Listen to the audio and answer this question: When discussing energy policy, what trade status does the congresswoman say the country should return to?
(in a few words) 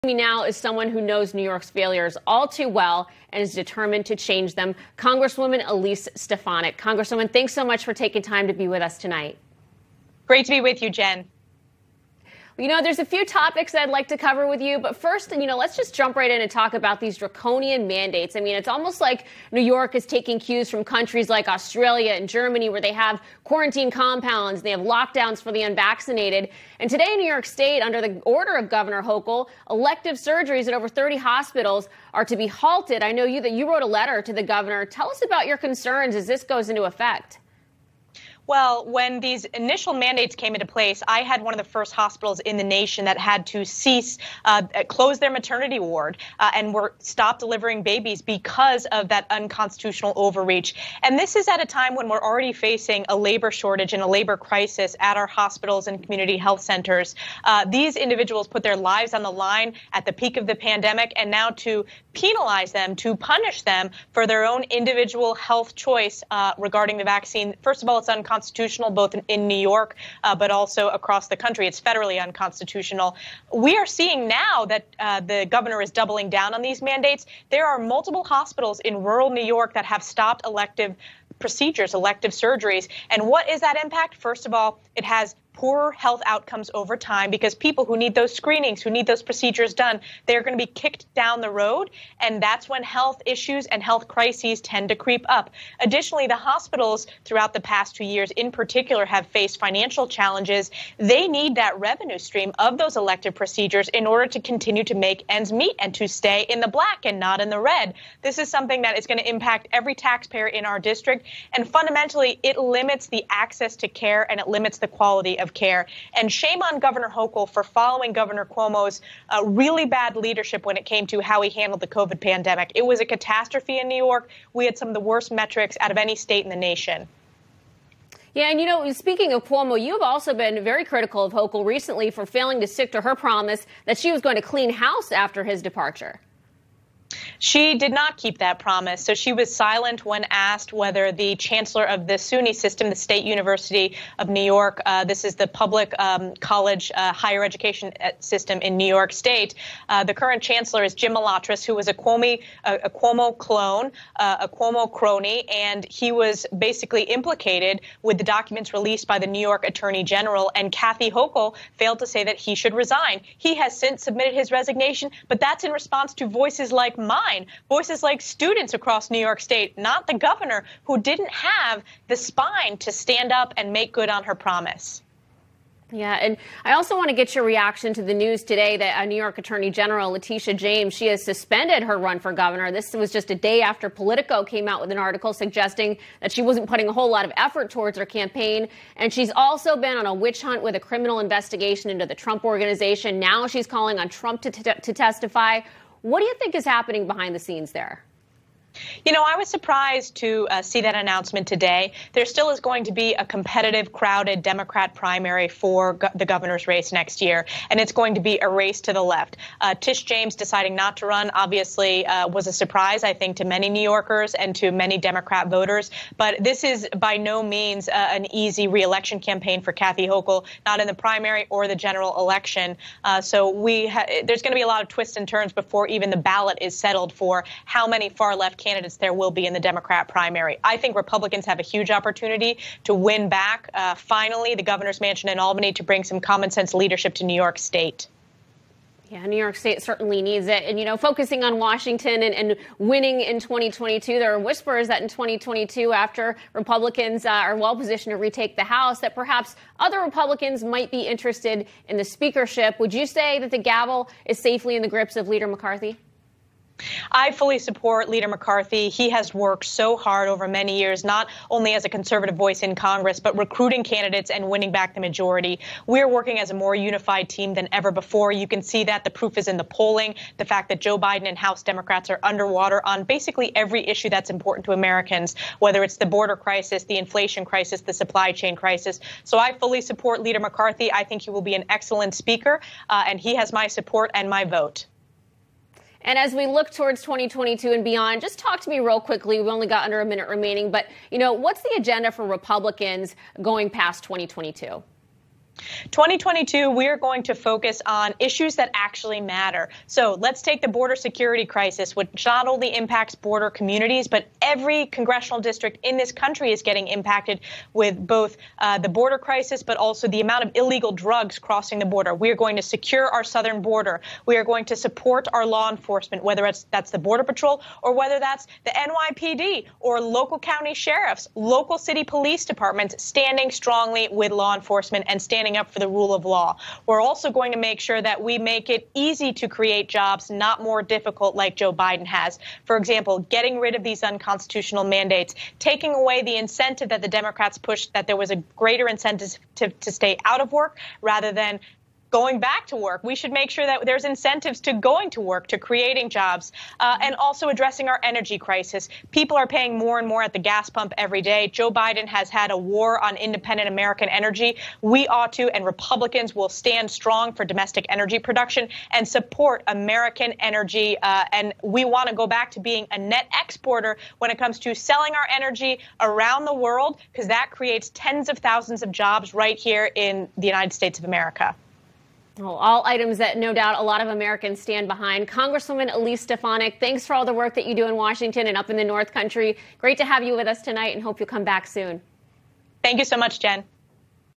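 net exporter.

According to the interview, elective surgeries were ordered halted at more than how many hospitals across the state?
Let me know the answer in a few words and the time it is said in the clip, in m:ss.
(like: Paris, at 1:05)
30, at 0:30.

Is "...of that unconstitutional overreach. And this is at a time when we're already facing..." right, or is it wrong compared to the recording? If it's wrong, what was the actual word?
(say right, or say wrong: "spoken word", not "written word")
right.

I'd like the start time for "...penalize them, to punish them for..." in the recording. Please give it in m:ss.
1:02.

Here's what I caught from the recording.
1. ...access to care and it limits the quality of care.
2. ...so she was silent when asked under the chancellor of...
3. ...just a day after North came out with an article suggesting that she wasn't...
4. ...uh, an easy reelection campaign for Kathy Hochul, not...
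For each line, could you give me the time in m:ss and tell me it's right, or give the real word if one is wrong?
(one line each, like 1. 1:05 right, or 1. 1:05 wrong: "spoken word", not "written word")
1. 1:53 right
2. 2:19 wrong: "whether", not "under"
3. 3:03 wrong: "Politico", not "North"
4. 3:37 right.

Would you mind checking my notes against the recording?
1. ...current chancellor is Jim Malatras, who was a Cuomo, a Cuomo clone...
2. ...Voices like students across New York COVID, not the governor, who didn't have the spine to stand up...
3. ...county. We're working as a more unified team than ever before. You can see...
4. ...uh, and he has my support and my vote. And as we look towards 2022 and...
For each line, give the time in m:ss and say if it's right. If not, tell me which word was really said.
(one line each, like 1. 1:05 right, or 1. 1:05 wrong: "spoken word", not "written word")
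1. 2:30 right
2. 2:47 wrong: "State", not "COVID"
3. 4:24 wrong: "majority", not "county"
4. 4:42 right.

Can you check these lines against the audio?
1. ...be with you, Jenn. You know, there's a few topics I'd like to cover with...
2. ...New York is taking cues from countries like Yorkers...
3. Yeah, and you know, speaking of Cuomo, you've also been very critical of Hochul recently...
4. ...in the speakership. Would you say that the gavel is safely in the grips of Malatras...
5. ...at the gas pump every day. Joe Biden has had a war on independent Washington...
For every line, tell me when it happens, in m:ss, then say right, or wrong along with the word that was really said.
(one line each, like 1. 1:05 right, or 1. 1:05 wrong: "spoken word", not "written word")
1. 0:10 right
2. 0:19 wrong: "Australia", not "Yorkers"
3. 2:08 right
4. 4:11 wrong: "Leader", not "Malatras"
5. 5:50 wrong: "American", not "Washington".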